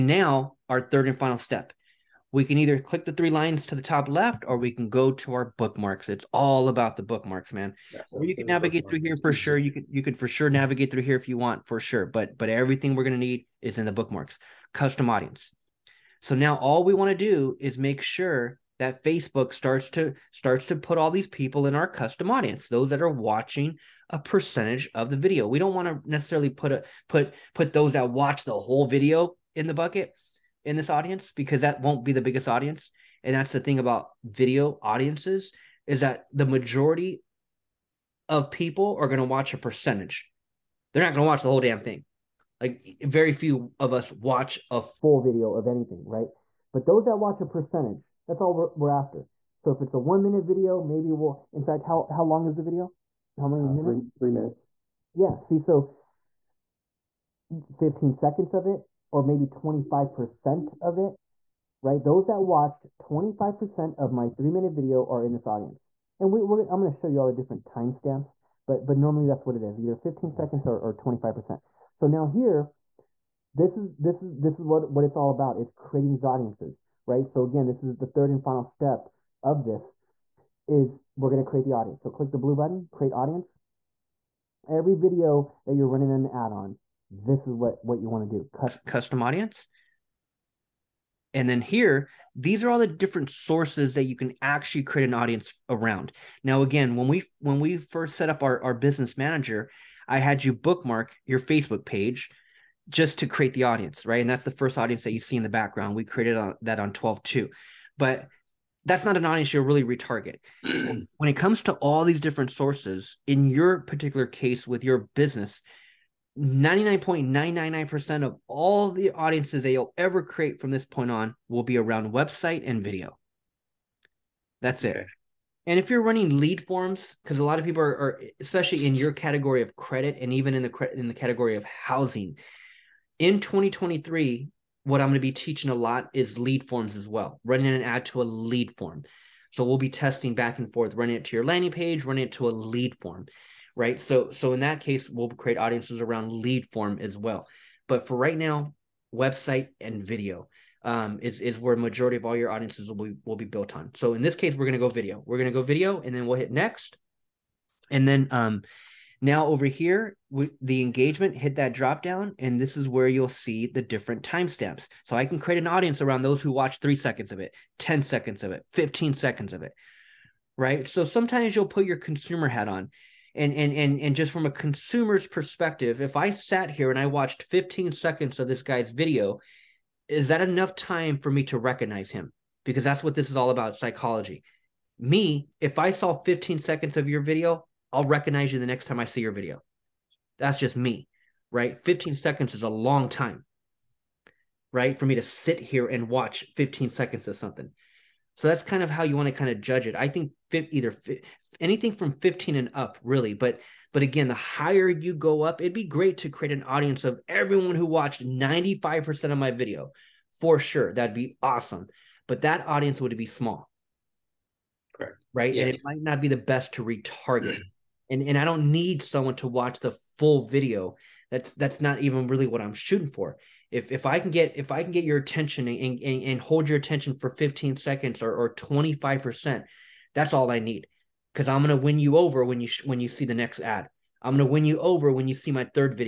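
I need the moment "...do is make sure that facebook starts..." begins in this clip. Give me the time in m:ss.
0:17.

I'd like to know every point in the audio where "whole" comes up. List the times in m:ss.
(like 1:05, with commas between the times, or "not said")
0:28, 0:41.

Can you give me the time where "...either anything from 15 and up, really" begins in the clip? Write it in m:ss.
3:20.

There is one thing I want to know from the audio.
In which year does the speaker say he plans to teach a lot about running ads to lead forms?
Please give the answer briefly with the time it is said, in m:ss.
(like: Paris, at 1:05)
2023, at 2:13.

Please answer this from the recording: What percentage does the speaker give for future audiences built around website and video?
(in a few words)
99.999%.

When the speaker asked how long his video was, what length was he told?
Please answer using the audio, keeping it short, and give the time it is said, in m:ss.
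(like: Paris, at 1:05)
3 minutes, at 0:54.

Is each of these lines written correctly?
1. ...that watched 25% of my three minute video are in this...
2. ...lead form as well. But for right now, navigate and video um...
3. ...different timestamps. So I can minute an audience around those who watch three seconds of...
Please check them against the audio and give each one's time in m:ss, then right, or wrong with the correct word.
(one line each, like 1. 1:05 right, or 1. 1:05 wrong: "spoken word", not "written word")
1. 1:02 right
2. 2:26 wrong: "website", not "navigate"
3. 2:43 wrong: "create", not "minute".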